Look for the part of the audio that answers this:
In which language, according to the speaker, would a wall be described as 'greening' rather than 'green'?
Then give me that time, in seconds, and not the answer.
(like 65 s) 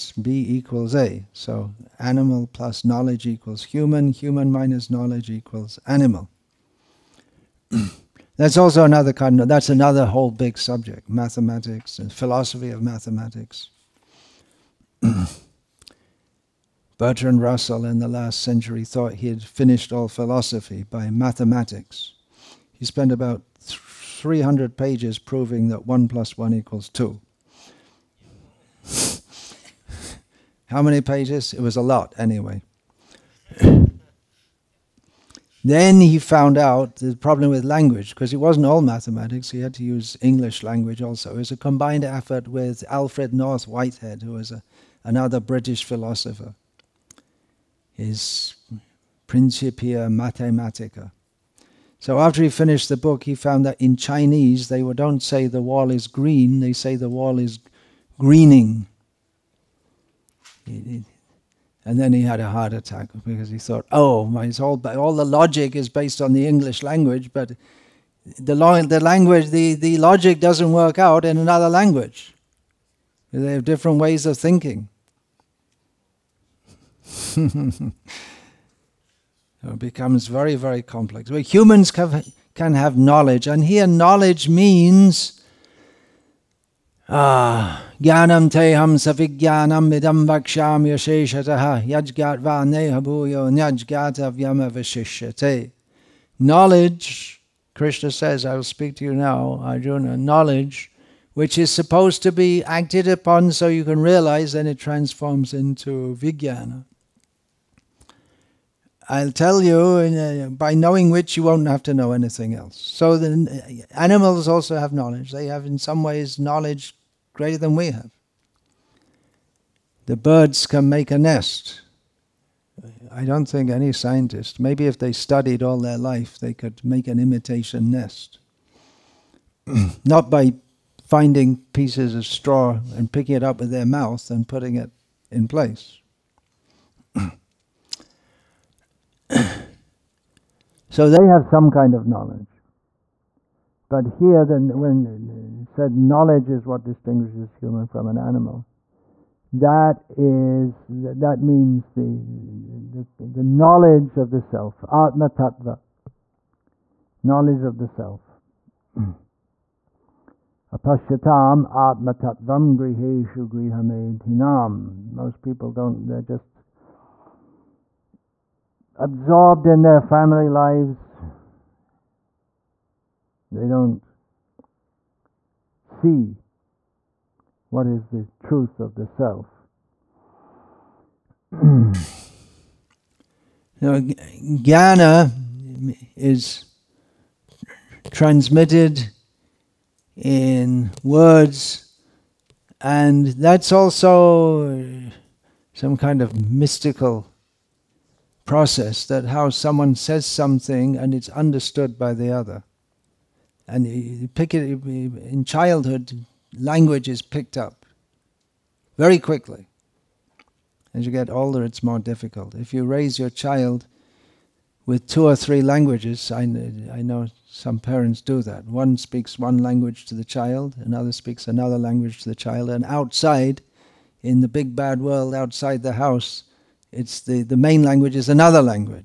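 53 s.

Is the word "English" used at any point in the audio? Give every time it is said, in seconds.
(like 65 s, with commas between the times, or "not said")
40 s, 66 s.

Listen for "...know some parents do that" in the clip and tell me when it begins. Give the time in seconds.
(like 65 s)
217 s.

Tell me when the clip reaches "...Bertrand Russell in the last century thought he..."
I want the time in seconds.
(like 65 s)
16 s.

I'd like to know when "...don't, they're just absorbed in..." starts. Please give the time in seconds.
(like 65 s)
165 s.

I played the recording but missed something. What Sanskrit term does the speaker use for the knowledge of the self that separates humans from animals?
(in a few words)
atma tattva.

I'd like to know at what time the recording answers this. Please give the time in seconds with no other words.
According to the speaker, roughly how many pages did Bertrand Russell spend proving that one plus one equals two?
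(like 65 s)
23 s.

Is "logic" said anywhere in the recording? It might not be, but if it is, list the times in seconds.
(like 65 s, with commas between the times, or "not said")
65 s, 69 s.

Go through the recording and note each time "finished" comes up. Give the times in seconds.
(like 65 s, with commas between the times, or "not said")
19 s, 52 s.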